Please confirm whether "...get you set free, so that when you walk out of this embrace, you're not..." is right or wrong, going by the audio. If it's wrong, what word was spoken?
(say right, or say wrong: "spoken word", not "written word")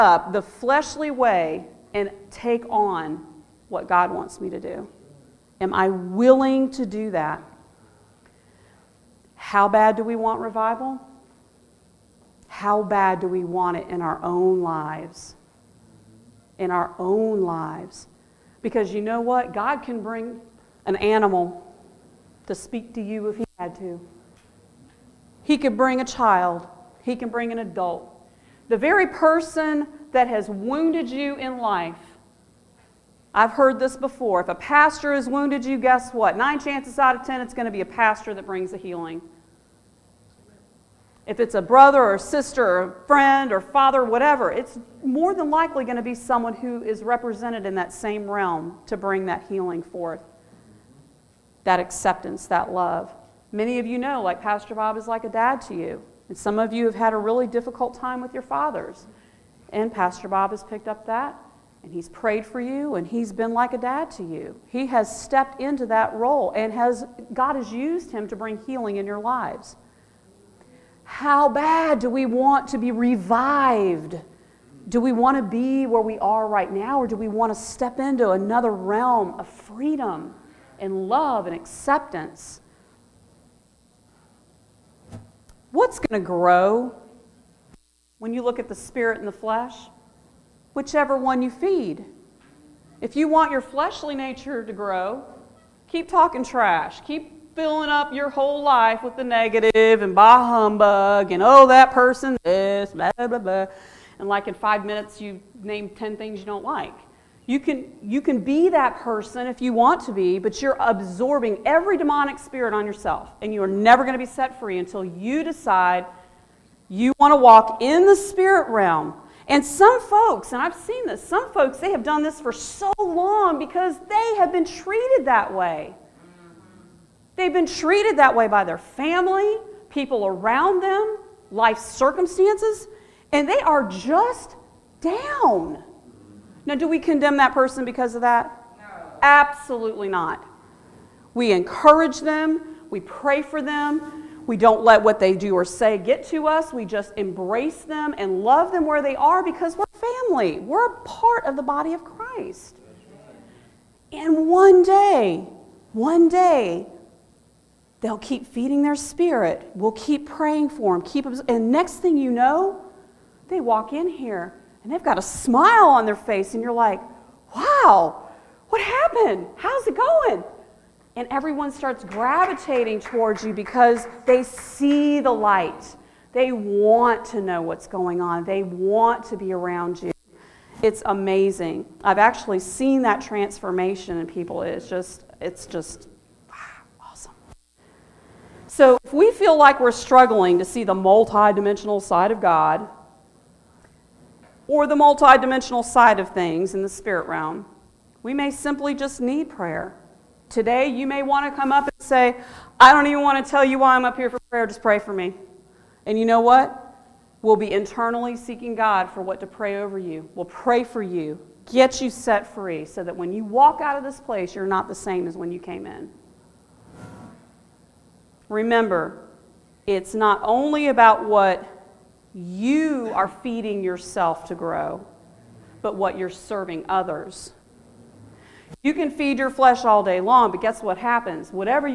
wrong: "place", not "embrace".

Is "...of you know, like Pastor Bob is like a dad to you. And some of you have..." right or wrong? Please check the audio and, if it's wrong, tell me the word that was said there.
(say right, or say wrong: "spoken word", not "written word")
right.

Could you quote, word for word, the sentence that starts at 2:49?
How's it going?" And everyone starts gravitating towards you because they see the light.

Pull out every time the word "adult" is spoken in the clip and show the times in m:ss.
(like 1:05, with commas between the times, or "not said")
0:27.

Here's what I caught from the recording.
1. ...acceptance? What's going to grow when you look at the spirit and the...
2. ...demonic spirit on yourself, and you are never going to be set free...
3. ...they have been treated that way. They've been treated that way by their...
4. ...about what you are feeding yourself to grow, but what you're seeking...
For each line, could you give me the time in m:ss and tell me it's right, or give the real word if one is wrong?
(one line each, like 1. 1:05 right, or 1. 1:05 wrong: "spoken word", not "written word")
1. 1:21 right
2. 1:51 right
3. 2:04 right
4. 3:40 wrong: "serving", not "seeking".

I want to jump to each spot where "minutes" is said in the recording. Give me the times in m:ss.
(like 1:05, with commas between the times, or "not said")
1:44.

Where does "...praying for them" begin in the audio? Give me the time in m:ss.
2:40.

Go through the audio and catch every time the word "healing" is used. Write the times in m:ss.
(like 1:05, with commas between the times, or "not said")
0:38, 0:49, 1:08.